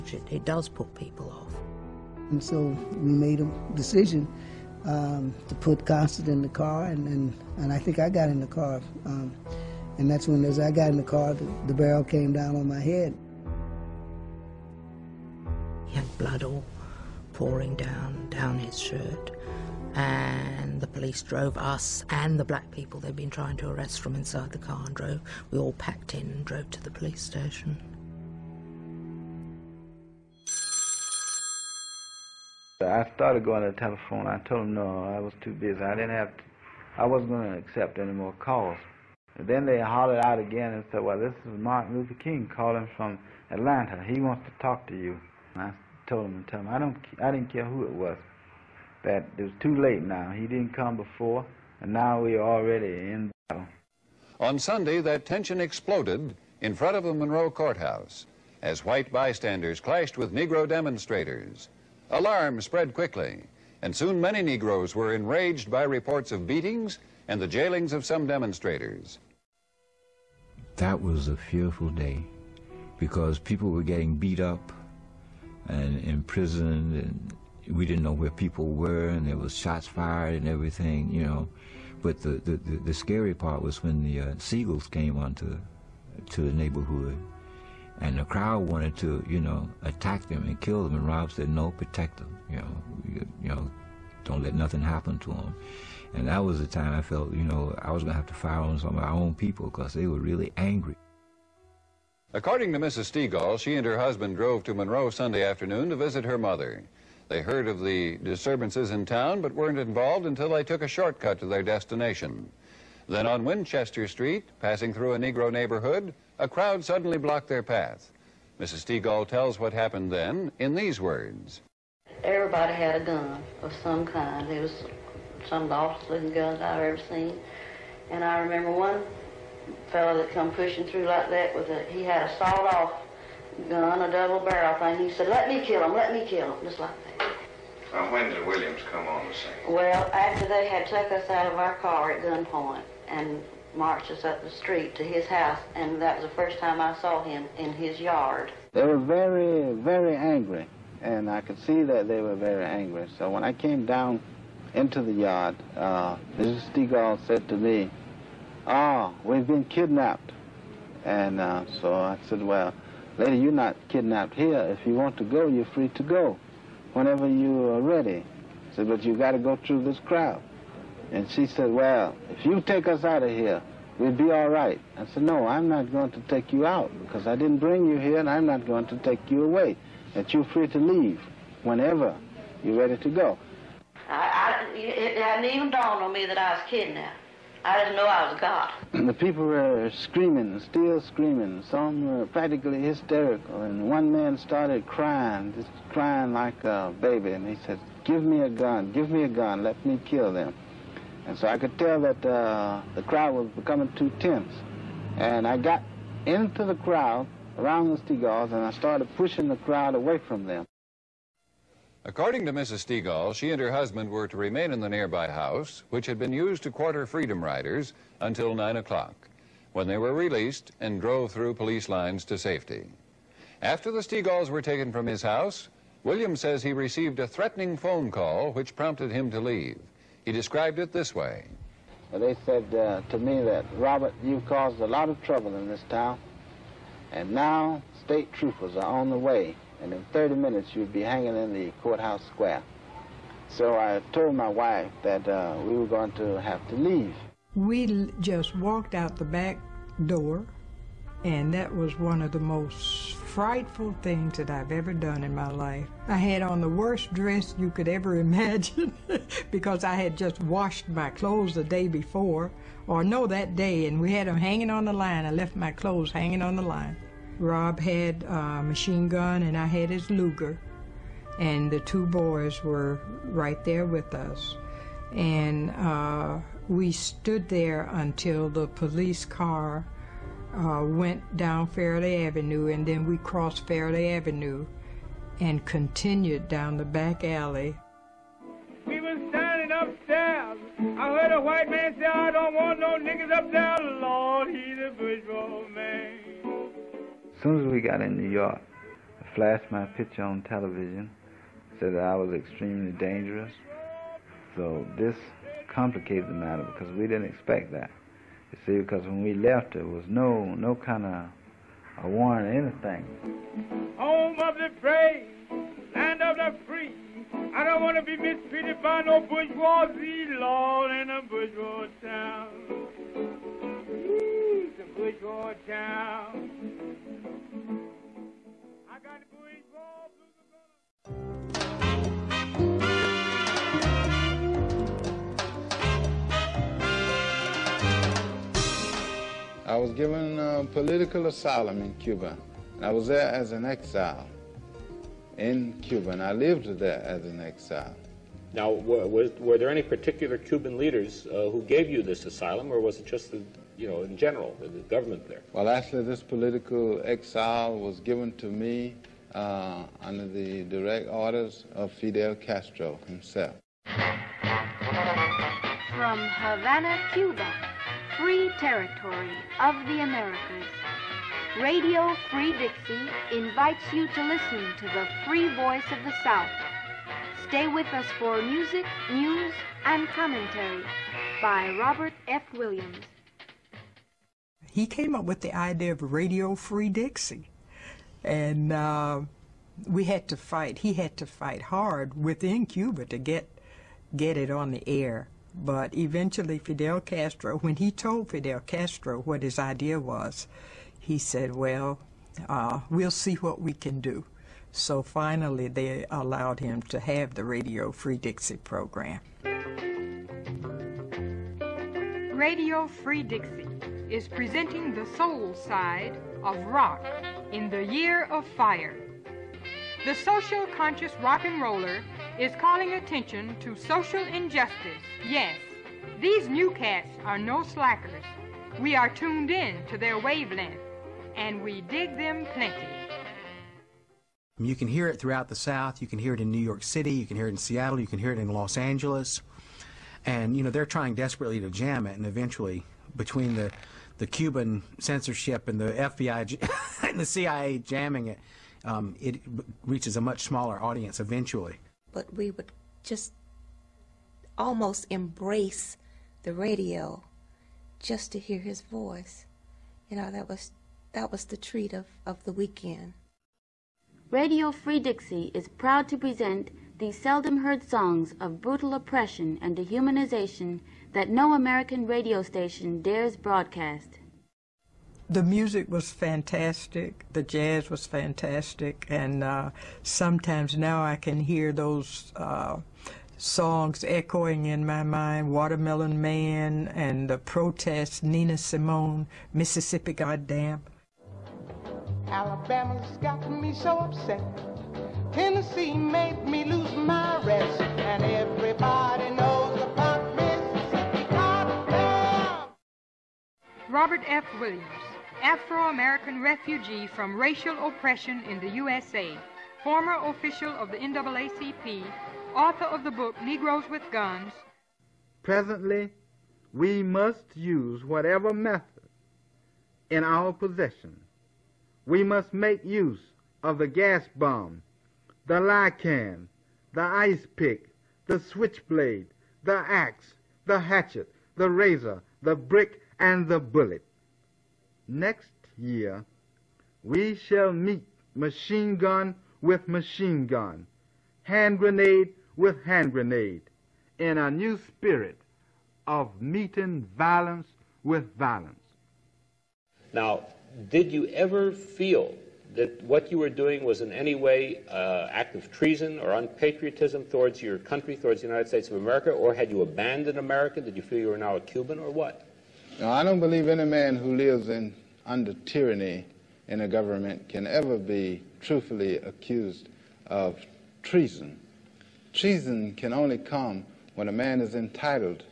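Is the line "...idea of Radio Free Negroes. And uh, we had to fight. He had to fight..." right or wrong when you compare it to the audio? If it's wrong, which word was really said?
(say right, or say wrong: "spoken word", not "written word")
wrong: "Dixie", not "Negroes".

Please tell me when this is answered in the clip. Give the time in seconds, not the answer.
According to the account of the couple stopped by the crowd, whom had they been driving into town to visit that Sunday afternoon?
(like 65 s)
106 s.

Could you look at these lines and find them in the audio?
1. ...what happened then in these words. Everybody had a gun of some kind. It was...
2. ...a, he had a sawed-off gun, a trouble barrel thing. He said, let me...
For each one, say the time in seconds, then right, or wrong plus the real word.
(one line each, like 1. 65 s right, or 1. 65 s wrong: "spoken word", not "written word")
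1. 119 s right
2. 131 s wrong: "double", not "trouble".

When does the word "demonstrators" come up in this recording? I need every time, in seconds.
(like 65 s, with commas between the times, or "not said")
60 s, 68 s.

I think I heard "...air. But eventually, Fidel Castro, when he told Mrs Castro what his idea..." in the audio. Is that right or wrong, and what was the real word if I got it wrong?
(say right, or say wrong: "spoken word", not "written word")
wrong: "Fidel", not "Mrs".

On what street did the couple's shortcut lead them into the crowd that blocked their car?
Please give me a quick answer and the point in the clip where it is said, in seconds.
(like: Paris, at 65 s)
Winchester Street, at 113 s.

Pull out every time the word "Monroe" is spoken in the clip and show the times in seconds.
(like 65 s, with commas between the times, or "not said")
57 s, 104 s.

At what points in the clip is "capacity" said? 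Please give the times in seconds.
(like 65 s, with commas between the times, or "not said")
not said.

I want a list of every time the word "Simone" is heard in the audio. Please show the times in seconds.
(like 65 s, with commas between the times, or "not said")
488 s.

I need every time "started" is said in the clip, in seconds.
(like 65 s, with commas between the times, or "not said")
33 s, 194 s, 208 s.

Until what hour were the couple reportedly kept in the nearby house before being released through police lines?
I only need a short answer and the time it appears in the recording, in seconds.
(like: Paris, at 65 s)
9 o'clock, at 218 s.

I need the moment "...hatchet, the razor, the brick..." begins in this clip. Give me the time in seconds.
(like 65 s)
530 s.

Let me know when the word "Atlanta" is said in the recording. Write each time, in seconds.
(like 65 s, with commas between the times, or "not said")
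43 s.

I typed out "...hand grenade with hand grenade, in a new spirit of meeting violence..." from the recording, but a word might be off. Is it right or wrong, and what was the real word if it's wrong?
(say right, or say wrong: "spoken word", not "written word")
right.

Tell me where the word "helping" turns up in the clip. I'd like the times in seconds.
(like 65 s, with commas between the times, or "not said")
not said.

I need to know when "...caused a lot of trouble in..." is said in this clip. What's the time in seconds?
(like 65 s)
234 s.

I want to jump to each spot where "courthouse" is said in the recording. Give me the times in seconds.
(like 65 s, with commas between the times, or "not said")
57 s, 241 s.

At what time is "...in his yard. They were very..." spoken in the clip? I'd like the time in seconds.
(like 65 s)
147 s.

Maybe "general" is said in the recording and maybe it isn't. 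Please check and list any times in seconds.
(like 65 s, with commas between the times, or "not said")
354 s.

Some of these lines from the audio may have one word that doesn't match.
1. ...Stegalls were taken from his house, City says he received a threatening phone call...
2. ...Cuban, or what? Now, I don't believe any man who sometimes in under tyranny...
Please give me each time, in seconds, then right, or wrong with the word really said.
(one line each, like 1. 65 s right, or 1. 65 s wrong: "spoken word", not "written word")
1. 224 s wrong: "William", not "City"
2. 561 s wrong: "lives", not "sometimes".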